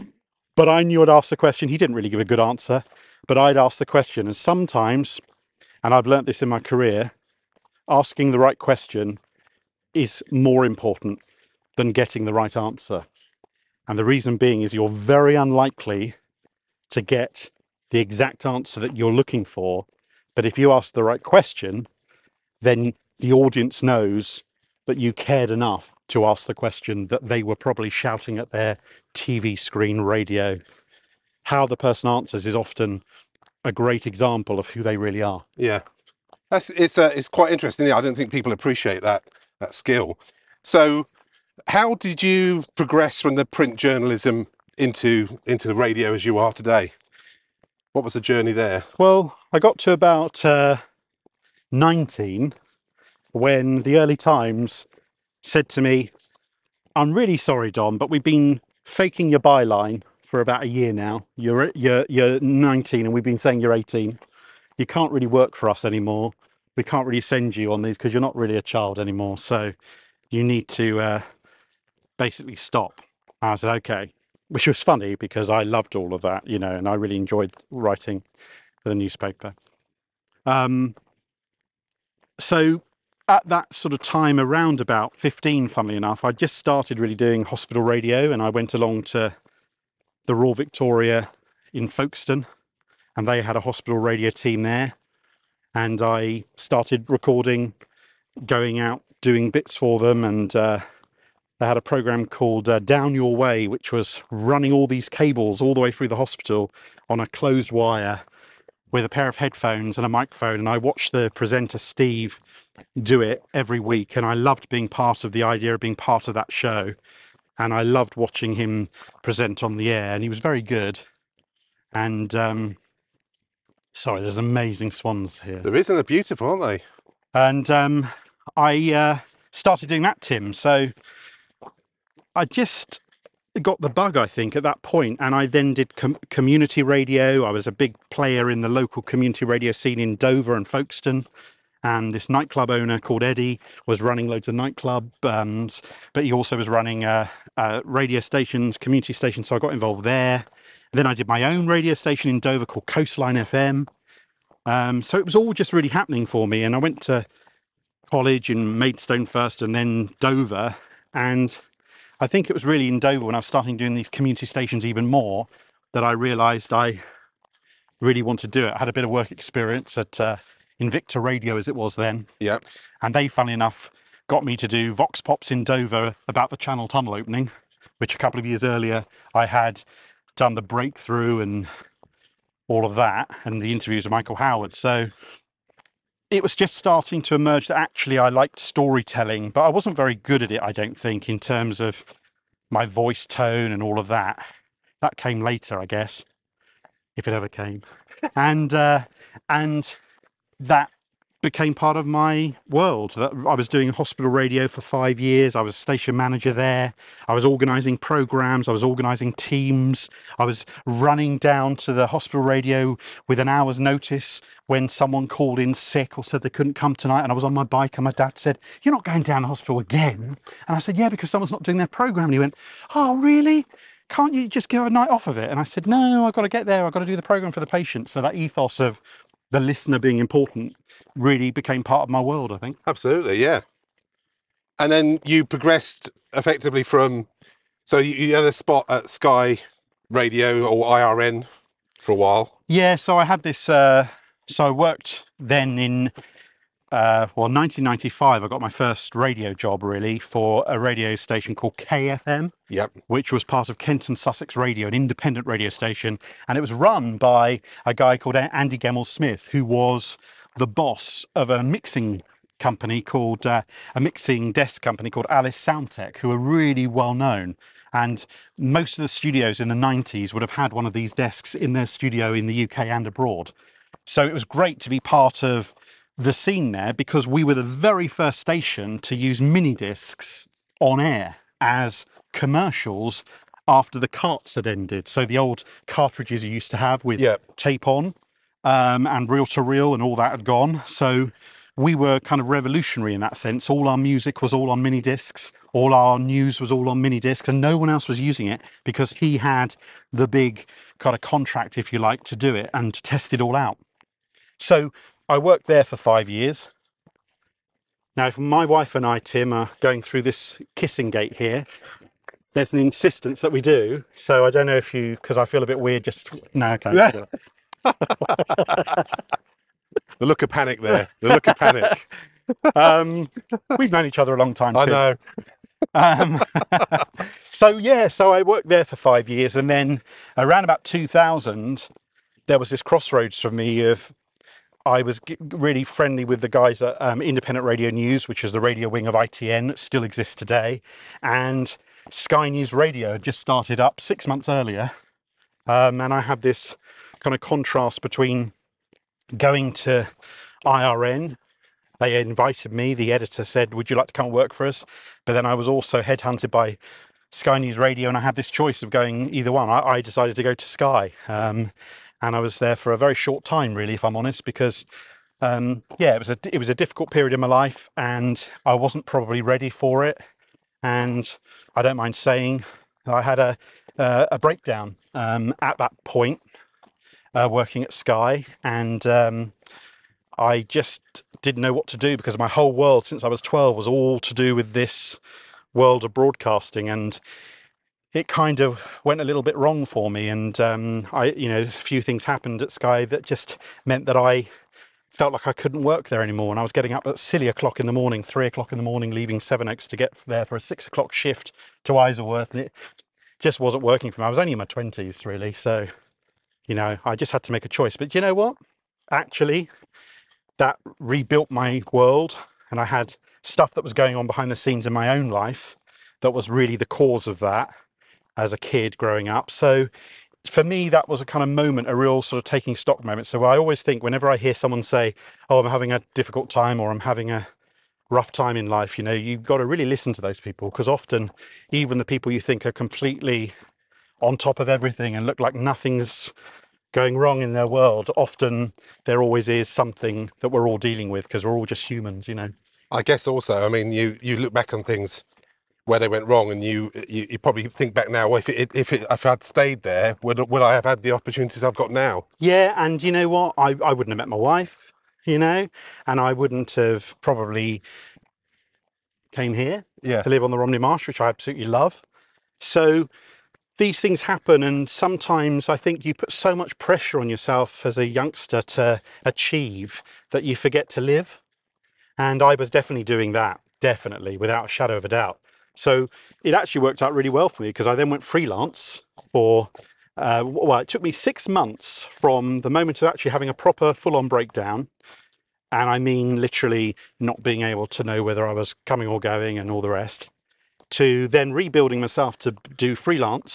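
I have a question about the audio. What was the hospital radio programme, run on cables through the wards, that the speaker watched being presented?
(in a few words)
Down Your Way.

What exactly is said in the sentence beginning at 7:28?
Well, if it, if it, if I'd stayed there, would would I have had the opportunities I've got now?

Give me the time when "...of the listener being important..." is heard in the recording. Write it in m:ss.
3:48.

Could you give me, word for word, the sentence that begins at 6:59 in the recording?
So for me, that was a kind of moment, a real sort of taking stock moment.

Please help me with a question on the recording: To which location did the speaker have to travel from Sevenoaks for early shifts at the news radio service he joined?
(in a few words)
Isleworth.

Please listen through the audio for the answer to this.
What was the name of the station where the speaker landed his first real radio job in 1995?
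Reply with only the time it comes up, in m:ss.
4:11.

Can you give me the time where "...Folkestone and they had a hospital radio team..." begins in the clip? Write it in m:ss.
1:31.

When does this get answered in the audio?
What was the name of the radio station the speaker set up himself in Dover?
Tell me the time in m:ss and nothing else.
2:32.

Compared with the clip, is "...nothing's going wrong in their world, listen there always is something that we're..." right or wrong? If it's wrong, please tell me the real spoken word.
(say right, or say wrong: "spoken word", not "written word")
wrong: "often", not "listen".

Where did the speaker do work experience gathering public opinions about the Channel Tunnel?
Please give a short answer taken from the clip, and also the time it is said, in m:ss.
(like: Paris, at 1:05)
Invicta Radio, at 2:50.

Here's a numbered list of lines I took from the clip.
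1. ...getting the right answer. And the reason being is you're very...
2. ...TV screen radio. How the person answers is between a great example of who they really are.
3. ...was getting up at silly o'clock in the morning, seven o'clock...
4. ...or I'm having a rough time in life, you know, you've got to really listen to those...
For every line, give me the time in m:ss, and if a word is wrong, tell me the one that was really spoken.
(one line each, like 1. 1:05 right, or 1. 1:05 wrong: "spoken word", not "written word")
1. 0:11 right
2. 0:29 wrong: "often", not "between"
3. 6:36 wrong: "three", not "seven"
4. 7:06 right.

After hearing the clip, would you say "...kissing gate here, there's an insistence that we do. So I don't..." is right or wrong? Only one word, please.
right.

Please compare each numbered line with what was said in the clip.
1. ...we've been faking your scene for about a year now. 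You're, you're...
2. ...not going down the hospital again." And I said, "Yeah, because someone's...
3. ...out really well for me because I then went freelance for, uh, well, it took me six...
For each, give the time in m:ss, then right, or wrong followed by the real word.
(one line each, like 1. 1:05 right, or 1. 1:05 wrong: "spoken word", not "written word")
1. 0:58 wrong: "byline", not "scene"
2. 3:38 right
3. 7:57 right.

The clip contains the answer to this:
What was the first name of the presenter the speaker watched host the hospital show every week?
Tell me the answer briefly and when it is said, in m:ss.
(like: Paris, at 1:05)
Steve, at 1:51.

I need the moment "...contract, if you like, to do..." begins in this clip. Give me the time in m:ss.
5:01.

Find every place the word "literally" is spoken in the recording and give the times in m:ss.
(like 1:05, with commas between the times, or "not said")
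8:06.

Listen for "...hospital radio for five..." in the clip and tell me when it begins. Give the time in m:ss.
3:23.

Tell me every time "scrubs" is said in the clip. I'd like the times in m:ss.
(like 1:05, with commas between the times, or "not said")
not said.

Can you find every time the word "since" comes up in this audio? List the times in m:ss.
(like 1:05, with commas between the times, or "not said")
6:23.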